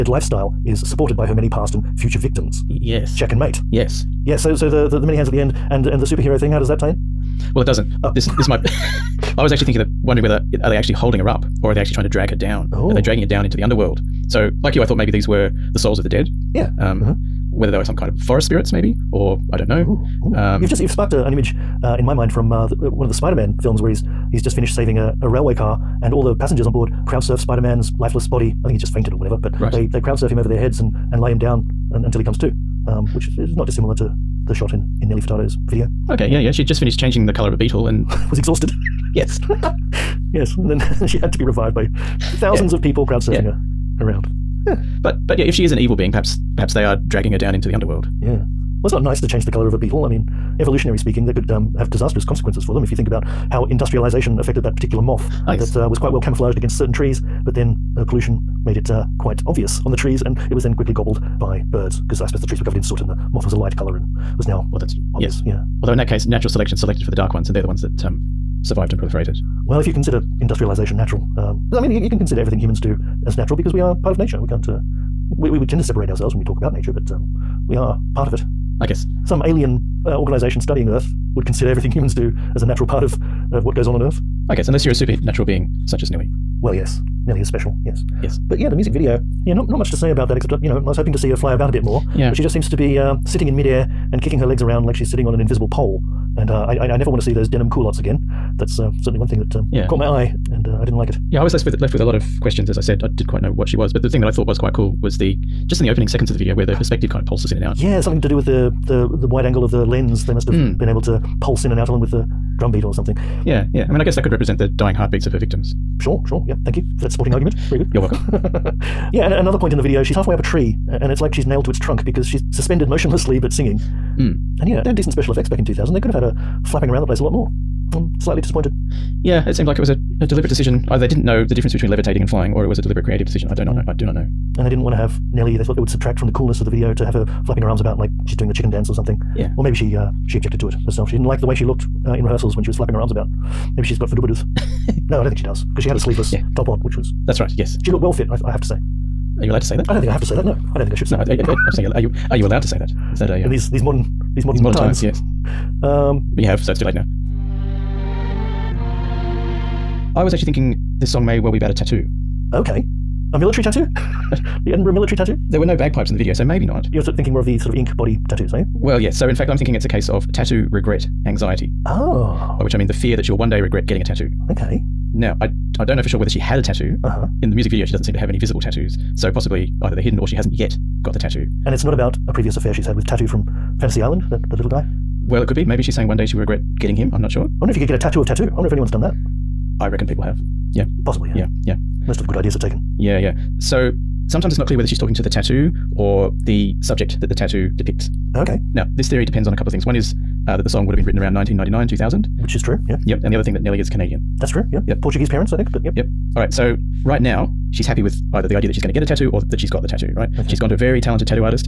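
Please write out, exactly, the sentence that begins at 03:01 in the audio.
And it's not about a previous affair she's had with Tattoo from Fantasy Island, that, that little guy?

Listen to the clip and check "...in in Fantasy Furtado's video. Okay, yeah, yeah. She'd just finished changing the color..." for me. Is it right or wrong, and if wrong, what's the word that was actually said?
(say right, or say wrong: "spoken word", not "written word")
wrong: "Nelly", not "Fantasy".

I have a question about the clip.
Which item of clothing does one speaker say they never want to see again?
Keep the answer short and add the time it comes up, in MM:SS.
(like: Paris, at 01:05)
denim culottes, at 01:37.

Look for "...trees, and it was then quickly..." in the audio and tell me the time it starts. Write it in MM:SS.
00:59.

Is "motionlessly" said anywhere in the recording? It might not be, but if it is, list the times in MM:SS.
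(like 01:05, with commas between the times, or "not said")
02:02.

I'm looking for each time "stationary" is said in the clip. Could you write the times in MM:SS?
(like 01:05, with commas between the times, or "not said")
not said.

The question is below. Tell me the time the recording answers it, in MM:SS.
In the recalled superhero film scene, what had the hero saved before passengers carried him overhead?
00:25.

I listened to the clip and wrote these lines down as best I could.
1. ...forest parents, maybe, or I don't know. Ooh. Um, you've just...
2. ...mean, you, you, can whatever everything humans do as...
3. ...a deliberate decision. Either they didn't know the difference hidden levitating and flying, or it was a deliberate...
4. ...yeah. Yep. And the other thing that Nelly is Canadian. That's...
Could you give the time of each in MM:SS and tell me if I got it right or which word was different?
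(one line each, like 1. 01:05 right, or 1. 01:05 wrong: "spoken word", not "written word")
1. 00:18 wrong: "spirits", not "parents"
2. 01:11 wrong: "consider", not "whatever"
3. 02:10 wrong: "between", not "hidden"
4. 03:22 right.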